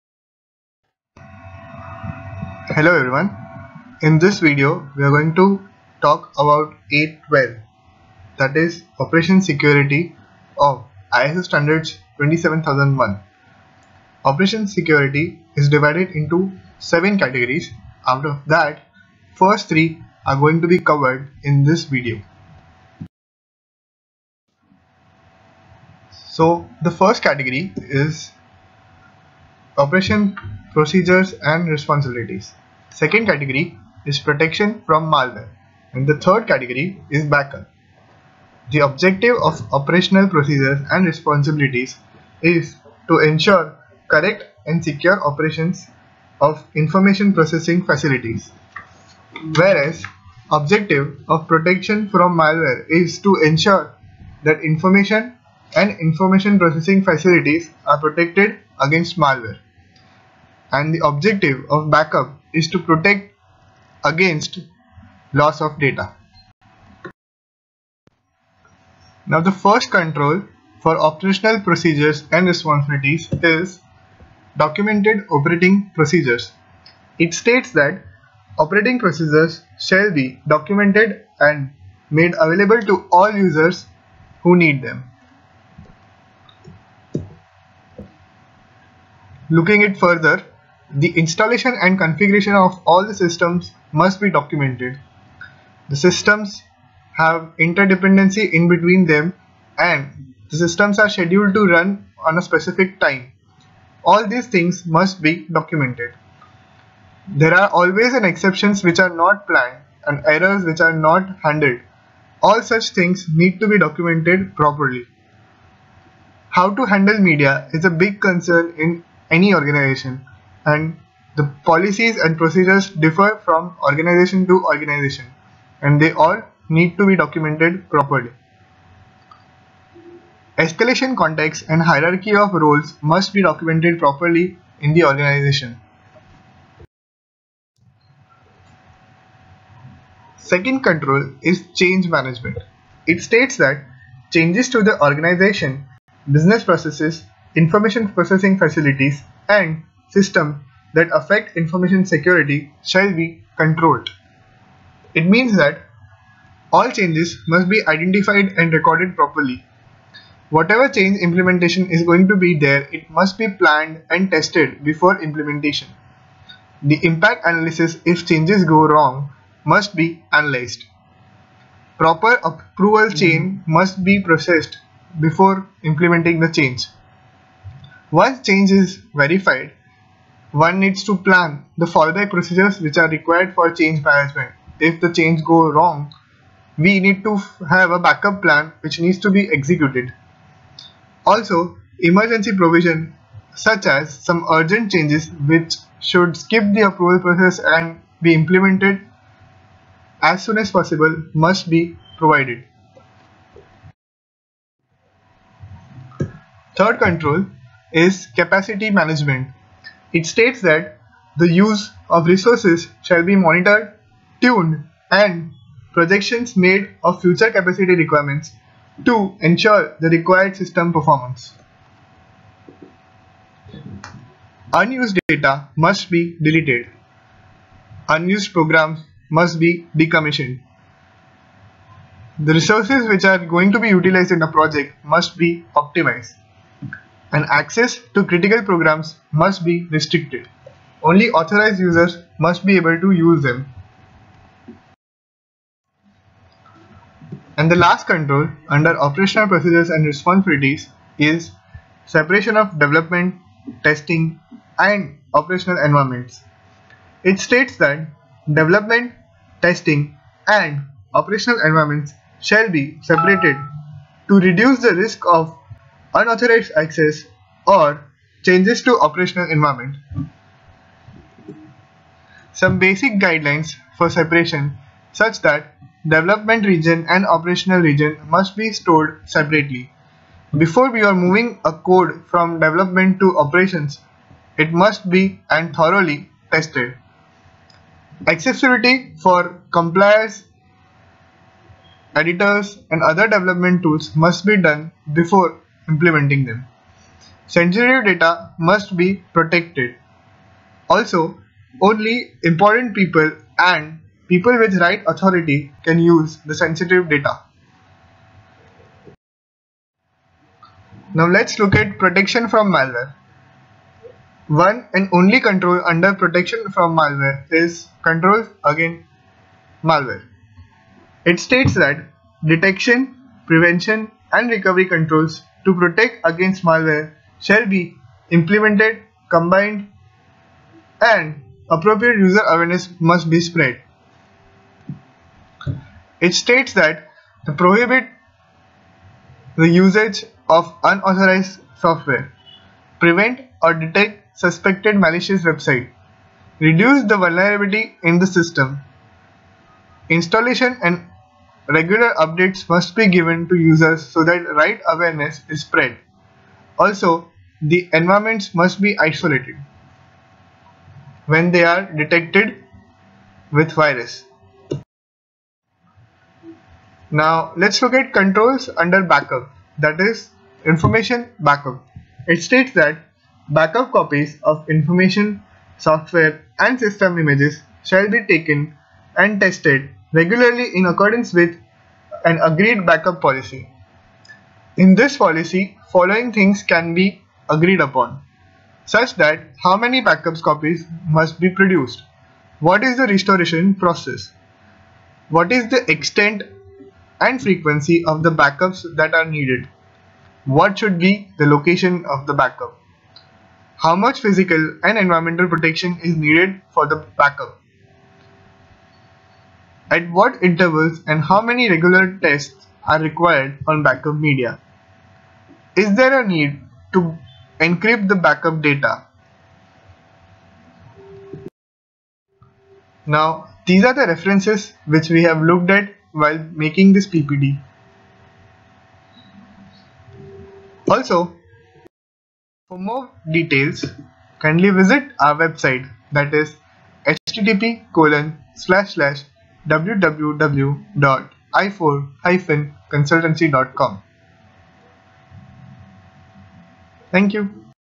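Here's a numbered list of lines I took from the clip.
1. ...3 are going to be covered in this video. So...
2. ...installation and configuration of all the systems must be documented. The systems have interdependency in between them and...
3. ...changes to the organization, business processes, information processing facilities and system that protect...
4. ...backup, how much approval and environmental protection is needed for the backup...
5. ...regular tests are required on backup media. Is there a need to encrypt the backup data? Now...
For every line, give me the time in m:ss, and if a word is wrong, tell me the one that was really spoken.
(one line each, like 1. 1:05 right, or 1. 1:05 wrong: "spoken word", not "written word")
1. 0:19 right
2. 1:31 right
3. 2:24 wrong: "affect", not "protect"
4. 6:42 wrong: "physical", not "approval"
5. 6:51 right.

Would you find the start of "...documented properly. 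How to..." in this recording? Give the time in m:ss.
1:53.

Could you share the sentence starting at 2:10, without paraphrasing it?
Escalation context and hierarchy of roles must be documented properly in the organization.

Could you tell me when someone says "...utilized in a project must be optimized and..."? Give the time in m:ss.
3:53.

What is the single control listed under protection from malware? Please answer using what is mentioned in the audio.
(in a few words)
Control against malware.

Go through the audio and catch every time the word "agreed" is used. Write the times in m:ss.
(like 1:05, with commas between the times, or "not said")
6:22, 6:27.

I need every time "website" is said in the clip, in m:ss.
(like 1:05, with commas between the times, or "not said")
5:45, 7:15.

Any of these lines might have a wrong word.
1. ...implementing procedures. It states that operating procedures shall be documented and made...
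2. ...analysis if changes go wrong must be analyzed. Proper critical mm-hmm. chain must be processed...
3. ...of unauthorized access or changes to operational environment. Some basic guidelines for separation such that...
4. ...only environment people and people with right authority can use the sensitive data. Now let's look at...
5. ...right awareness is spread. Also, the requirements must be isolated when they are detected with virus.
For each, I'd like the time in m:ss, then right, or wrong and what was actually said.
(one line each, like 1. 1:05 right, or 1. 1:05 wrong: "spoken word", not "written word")
1. 1:15 wrong: "operating", not "implementing"
2. 2:47 wrong: "approval", not "critical"
3. 4:25 right
4. 5:01 wrong: "important", not "environment"
5. 5:54 wrong: "environments", not "requirements".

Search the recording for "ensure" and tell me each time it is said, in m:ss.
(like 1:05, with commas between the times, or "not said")
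0:43, 0:53, 3:39.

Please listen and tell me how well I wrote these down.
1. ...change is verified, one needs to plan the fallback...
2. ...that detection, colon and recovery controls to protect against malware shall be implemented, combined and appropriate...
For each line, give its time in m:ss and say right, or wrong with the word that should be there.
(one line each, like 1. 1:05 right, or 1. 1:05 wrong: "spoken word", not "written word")
1. 2:58 right
2. 5:21 wrong: "prevention", not "colon".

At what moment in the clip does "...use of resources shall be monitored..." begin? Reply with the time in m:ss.
3:31.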